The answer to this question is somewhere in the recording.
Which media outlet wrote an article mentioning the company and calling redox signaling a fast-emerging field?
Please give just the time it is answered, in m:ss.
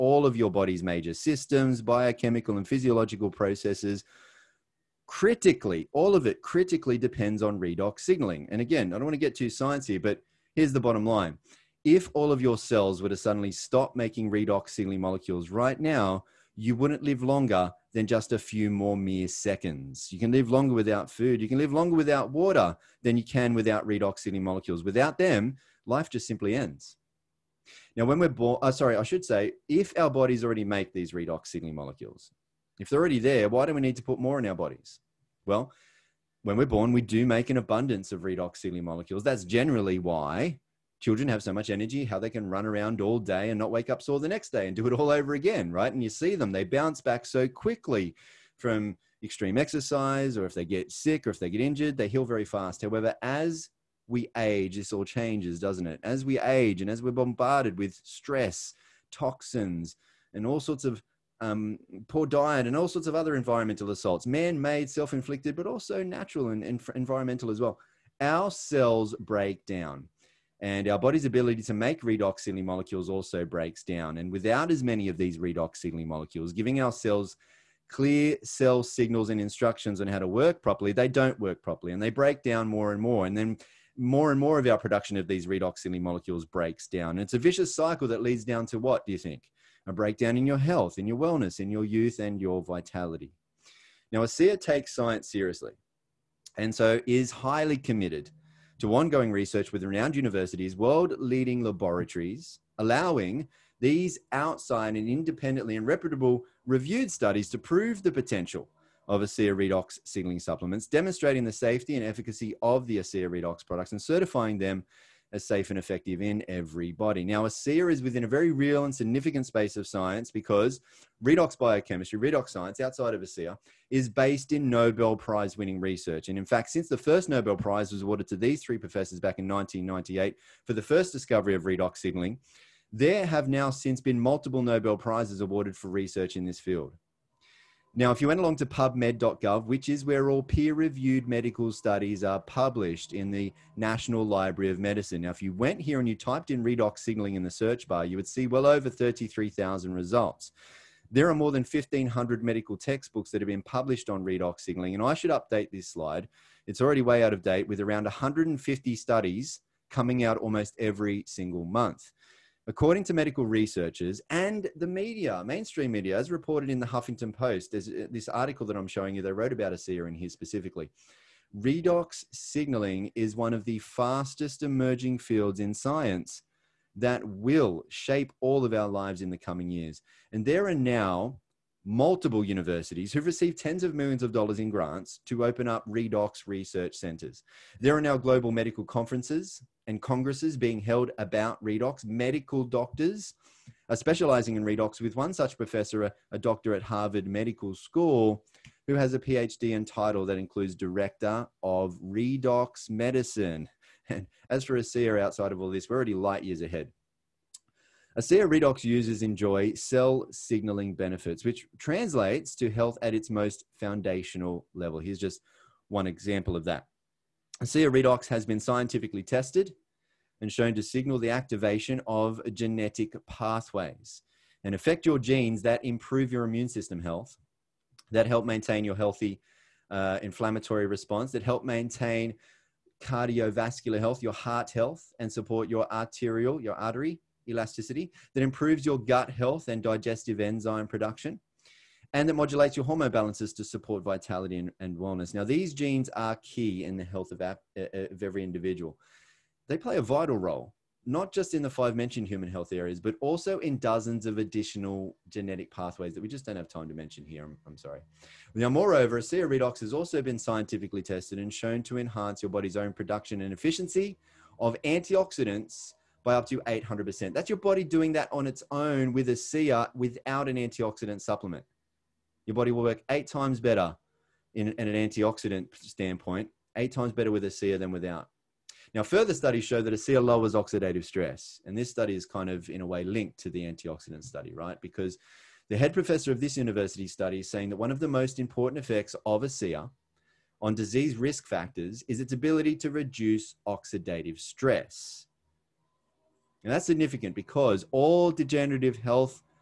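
2:46.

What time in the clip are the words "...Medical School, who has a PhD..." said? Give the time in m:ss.
3:17.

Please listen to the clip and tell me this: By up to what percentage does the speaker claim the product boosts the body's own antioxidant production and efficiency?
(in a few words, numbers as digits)
800%.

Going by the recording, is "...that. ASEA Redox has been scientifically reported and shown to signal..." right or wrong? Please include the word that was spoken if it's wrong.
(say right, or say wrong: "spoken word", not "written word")
wrong: "tested", not "reported".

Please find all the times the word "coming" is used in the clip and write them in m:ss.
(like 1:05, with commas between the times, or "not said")
2:39, 2:59.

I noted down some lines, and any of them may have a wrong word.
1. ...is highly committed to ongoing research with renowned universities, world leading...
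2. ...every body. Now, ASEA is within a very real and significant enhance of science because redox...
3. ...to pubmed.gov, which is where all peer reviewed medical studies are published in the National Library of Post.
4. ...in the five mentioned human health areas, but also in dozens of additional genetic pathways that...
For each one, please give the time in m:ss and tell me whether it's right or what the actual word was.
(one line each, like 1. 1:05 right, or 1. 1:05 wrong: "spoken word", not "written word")
1. 1:37 right
2. 1:56 wrong: "space", not "enhance"
3. 2:18 wrong: "Medicine", not "Post"
4. 4:11 right.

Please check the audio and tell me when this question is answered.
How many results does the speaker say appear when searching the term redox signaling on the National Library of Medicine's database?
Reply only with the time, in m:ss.
2:28.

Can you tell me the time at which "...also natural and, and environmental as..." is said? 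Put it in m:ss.
1:05.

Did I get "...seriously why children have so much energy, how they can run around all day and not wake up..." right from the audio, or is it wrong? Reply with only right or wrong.
wrong.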